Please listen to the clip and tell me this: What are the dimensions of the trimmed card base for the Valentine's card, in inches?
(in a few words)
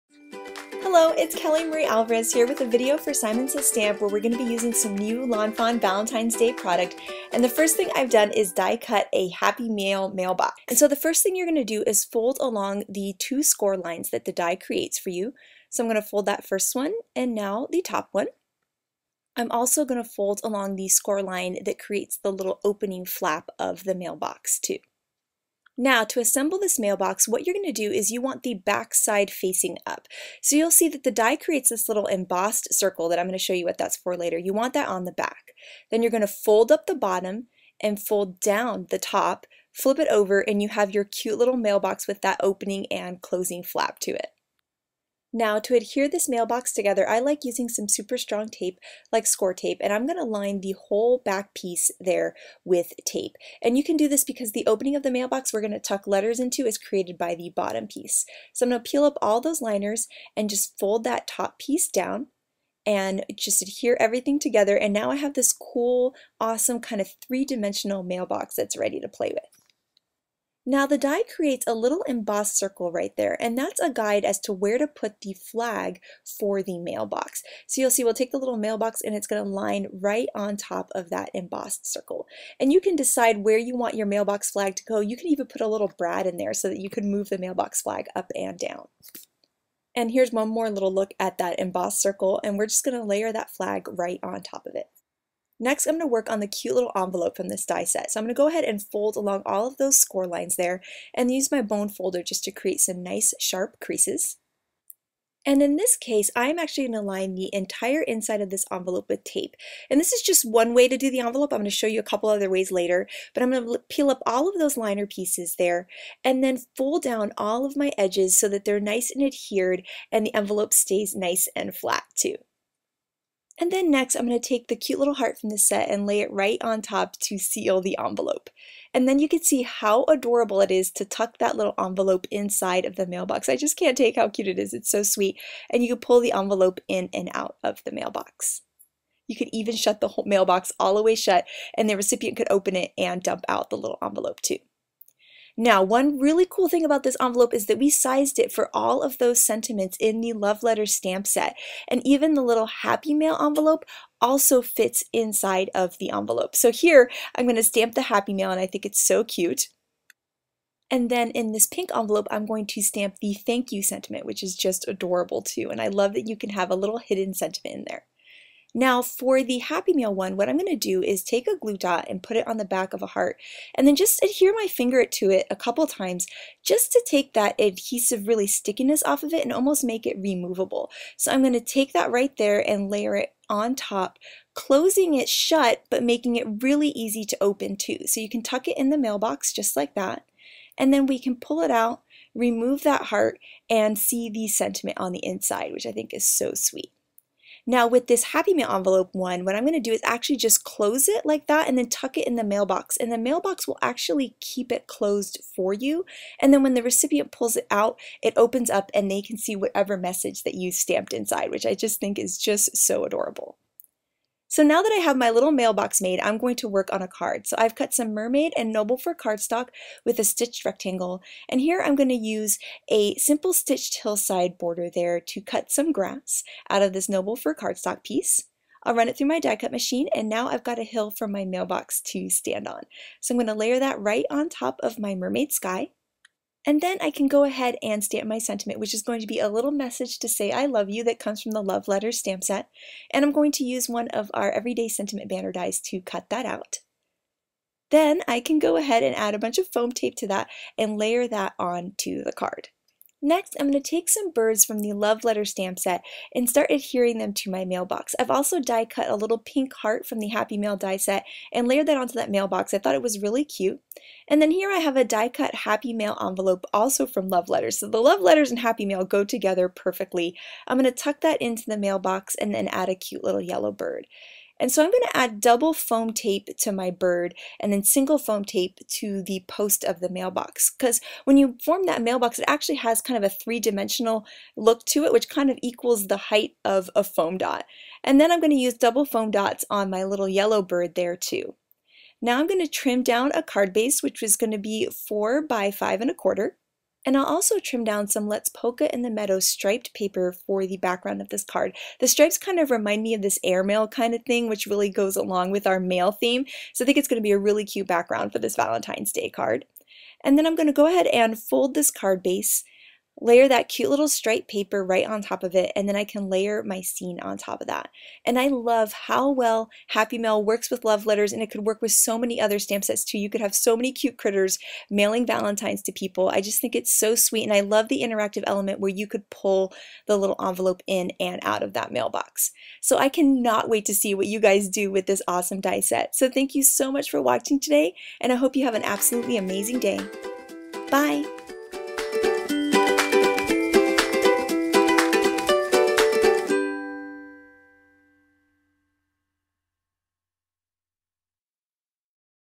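4 by 5 1/4.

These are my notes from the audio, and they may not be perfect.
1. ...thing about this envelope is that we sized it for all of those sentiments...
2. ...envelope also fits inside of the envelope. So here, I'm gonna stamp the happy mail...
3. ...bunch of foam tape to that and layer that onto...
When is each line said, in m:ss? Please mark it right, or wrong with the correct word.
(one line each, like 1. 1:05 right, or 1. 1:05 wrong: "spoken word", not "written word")
1. 2:26 right
2. 2:33 right
3. 4:09 right.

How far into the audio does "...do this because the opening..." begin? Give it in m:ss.
0:53.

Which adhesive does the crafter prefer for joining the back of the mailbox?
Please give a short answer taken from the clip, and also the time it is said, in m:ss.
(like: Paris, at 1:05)
Score tape, at 0:49.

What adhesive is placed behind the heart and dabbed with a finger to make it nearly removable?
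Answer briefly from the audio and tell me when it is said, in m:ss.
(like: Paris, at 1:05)
Glue dot, at 2:51.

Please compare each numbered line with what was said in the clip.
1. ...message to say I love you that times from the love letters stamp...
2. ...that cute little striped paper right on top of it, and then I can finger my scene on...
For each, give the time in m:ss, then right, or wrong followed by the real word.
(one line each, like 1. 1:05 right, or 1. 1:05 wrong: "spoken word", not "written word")
1. 3:59 wrong: "comes", not "times"
2. 5:13 wrong: "layer", not "finger".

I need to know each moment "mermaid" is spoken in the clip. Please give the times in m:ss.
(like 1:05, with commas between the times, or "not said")
3:38, 3:55.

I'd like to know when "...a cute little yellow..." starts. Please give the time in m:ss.
4:32.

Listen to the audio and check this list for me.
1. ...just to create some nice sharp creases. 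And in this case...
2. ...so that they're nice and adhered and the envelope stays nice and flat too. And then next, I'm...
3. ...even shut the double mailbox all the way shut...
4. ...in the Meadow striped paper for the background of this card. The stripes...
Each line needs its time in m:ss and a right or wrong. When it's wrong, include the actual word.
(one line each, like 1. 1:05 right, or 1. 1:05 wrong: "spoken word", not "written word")
1. 1:42 right
2. 1:58 right
3. 2:19 wrong: "whole", not "double"
4. 4:58 right.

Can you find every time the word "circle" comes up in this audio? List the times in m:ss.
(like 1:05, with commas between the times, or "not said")
0:32, 1:12, 1:21, 1:32.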